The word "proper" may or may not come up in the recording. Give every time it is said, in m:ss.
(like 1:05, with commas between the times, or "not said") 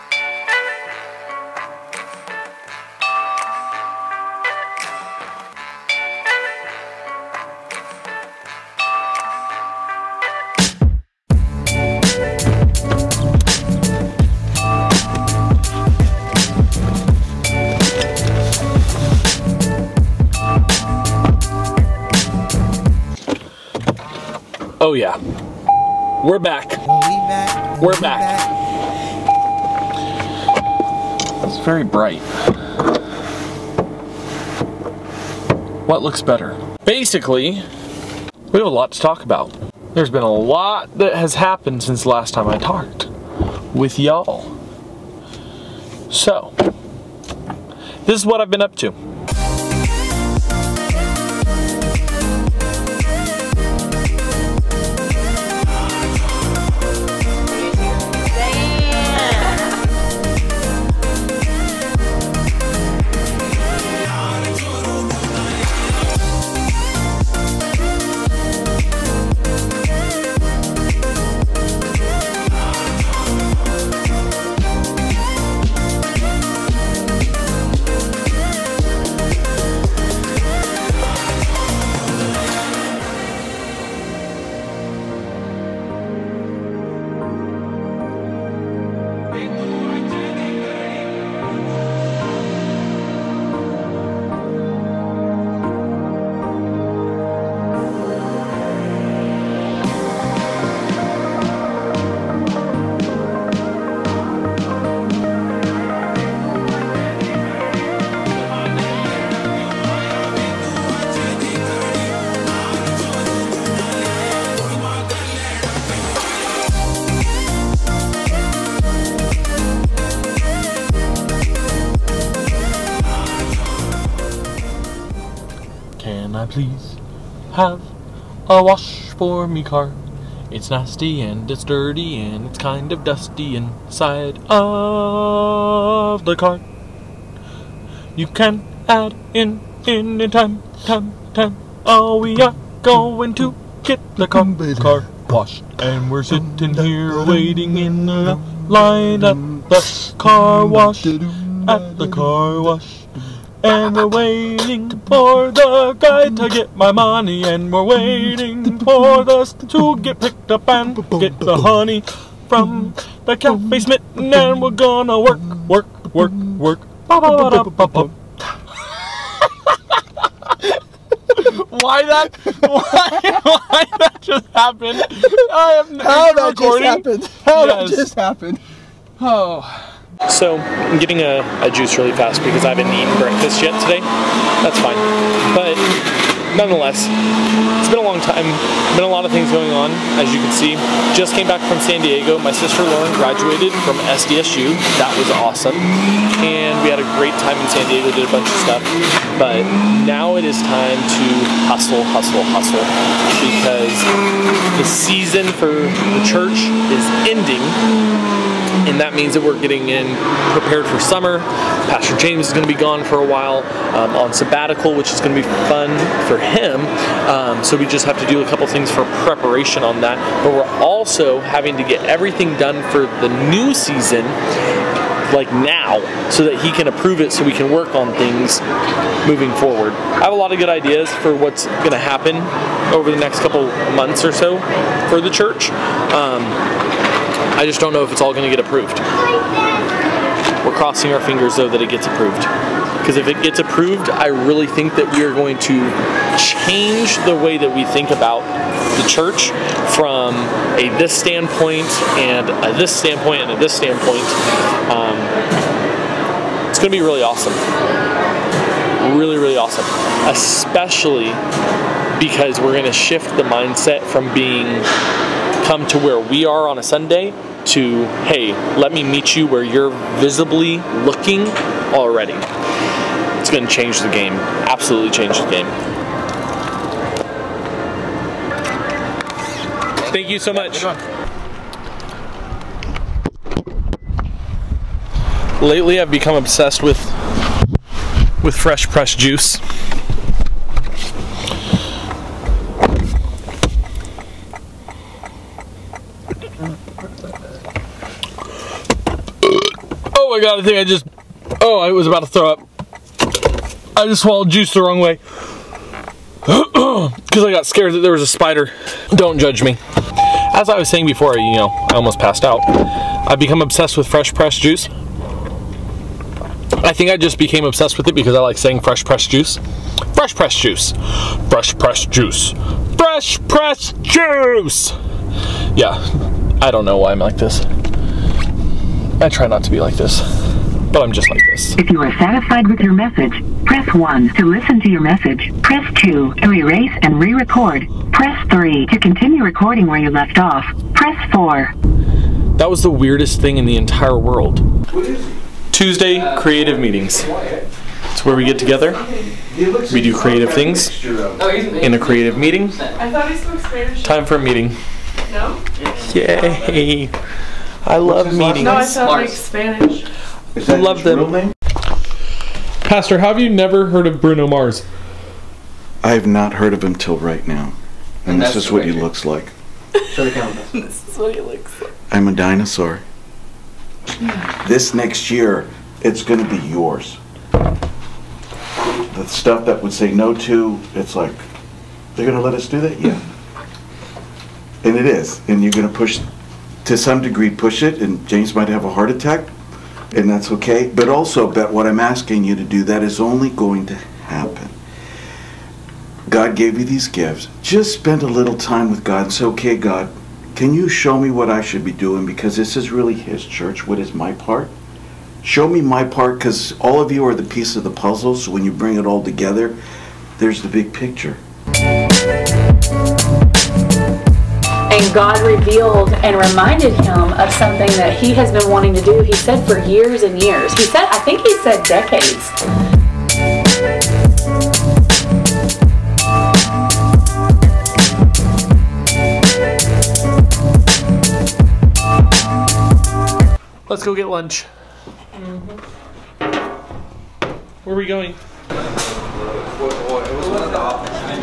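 not said.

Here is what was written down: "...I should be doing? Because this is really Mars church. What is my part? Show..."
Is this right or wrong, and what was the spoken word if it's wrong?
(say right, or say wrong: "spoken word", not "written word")
wrong: "His", not "Mars".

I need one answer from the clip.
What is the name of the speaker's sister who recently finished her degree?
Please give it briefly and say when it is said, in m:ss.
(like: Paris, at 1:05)
Lauren, at 3:12.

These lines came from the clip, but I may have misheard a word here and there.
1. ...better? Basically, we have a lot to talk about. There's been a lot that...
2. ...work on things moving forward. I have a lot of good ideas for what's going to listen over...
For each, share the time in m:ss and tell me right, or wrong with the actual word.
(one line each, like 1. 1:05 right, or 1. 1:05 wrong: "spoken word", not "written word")
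1. 0:36 right
2. 3:47 wrong: "happen", not "listen".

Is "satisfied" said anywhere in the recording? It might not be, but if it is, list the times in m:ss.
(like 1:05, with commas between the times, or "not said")
5:32.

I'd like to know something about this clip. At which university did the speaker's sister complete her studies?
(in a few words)
SDSU.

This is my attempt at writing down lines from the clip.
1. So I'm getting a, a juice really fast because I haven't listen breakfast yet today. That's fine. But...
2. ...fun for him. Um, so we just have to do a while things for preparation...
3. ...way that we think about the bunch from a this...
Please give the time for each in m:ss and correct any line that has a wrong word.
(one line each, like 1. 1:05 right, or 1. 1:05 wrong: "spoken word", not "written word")
1. 3:00 wrong: "eaten", not "listen"
2. 3:35 wrong: "couple", not "while"
3. 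4:07 wrong: "church", not "bunch".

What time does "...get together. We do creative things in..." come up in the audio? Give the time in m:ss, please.
5:48.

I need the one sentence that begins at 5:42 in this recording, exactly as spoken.
That was the weirdest thing in the entire world.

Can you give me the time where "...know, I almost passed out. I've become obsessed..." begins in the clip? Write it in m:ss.
5:11.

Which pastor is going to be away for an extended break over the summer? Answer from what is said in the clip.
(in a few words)
Pastor James.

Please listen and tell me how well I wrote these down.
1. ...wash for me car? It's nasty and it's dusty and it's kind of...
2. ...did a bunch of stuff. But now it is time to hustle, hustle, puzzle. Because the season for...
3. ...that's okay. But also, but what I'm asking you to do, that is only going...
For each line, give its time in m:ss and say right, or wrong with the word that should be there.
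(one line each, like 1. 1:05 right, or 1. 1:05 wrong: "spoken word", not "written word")
1. 2:08 wrong: "dirty", not "dusty"
2. 3:18 wrong: "hustle", not "puzzle"
3. 6:30 right.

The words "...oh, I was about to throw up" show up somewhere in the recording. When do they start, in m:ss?
5:01.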